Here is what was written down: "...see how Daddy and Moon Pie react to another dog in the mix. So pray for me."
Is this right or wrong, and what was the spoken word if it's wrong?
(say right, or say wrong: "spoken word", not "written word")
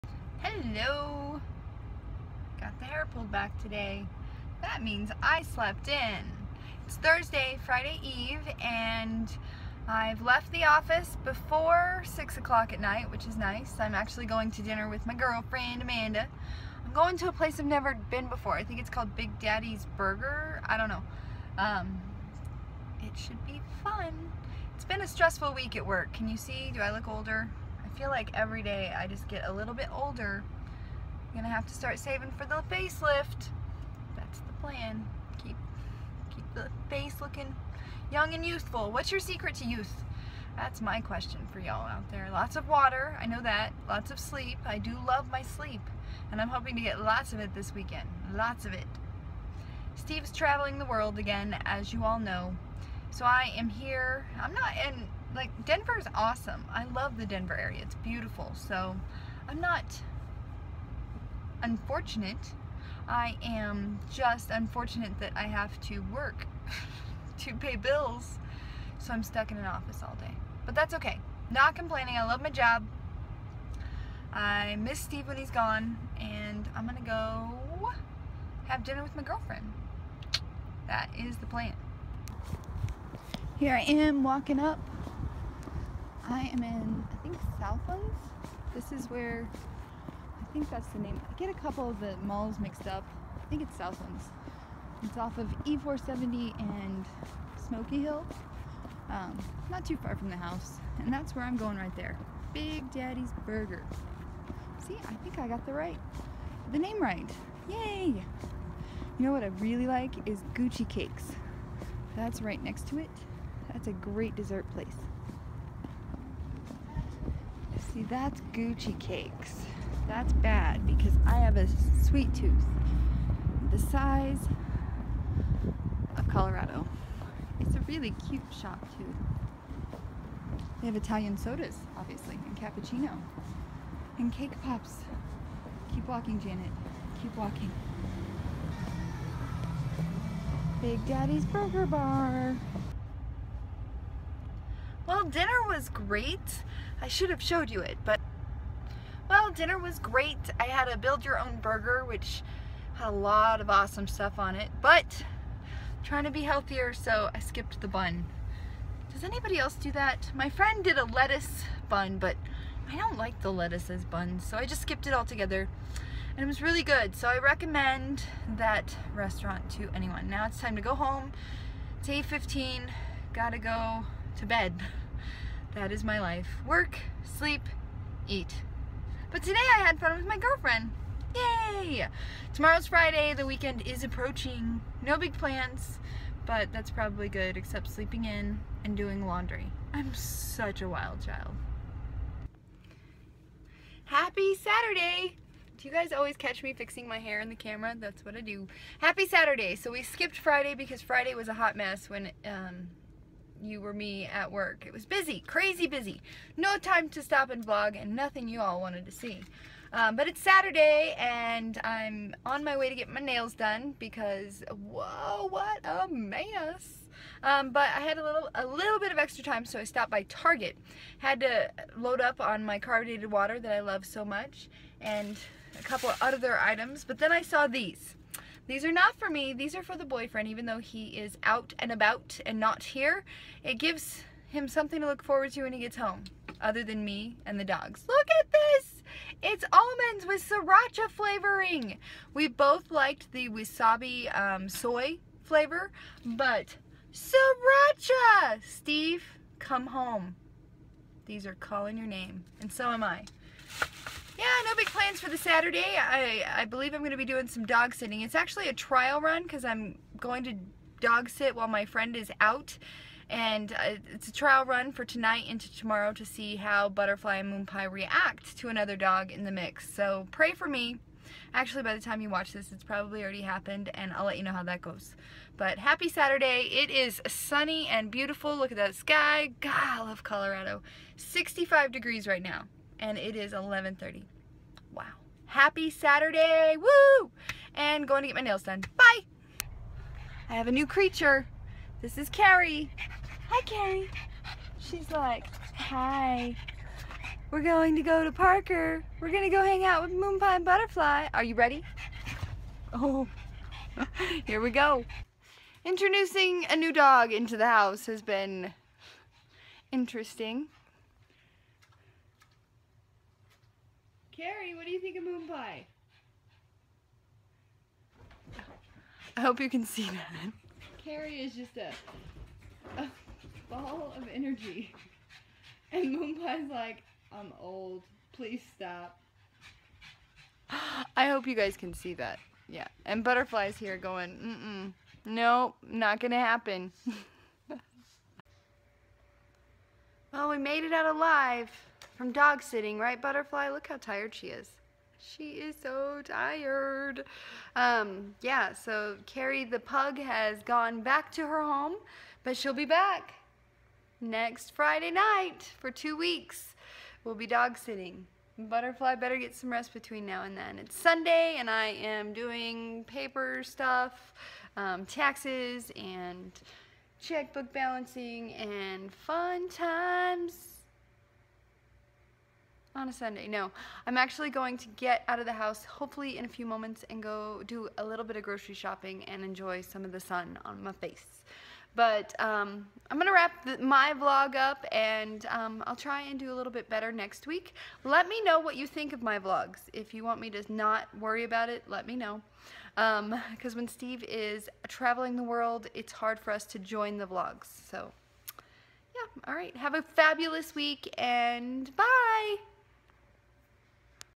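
wrong: "Butterfly", not "Daddy".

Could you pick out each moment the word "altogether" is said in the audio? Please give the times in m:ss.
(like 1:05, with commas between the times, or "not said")
2:45.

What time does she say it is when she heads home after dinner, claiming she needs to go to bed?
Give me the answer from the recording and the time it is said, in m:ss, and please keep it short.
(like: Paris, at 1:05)
8:15, at 2:52.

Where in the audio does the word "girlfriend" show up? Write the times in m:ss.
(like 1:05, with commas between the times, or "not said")
0:15, 1:19, 3:00.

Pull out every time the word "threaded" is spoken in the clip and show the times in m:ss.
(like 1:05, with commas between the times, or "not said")
not said.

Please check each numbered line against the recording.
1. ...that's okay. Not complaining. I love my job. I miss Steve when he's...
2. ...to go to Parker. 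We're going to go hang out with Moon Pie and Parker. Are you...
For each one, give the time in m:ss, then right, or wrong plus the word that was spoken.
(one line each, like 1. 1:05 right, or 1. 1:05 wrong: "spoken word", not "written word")
1. 1:10 right
2. 4:57 wrong: "Butterfly", not "Parker".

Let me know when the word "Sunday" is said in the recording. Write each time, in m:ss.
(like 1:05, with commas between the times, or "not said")
6:00, 6:13.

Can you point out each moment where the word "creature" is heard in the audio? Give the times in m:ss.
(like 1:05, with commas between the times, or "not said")
4:50.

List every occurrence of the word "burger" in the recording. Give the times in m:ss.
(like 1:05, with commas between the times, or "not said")
0:19, 1:43, 2:21, 2:31.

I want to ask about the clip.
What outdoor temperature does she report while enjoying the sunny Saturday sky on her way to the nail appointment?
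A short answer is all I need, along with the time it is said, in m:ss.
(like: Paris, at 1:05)
65 degrees, at 4:41.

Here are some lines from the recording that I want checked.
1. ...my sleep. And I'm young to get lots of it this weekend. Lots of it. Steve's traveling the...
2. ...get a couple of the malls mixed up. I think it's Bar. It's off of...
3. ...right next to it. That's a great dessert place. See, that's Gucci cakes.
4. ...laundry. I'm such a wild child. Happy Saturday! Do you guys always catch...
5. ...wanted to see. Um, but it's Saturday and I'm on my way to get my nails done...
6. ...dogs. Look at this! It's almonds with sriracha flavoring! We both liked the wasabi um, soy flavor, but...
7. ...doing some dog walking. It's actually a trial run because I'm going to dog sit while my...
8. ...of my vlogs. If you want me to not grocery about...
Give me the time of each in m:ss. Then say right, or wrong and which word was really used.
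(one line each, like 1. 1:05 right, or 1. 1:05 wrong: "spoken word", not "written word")
1. 0:45 wrong: "hoping", not "young"
2. 1:31 wrong: "Southlands", not "Bar"
3. 1:52 right
4. 3:09 right
5. 3:28 right
6. 3:57 right
7. 4:17 wrong: "sitting", not "walking"
8. 6:29 wrong: "worry", not "grocery".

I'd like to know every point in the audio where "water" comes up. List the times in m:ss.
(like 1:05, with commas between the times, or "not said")
0:42, 3:43.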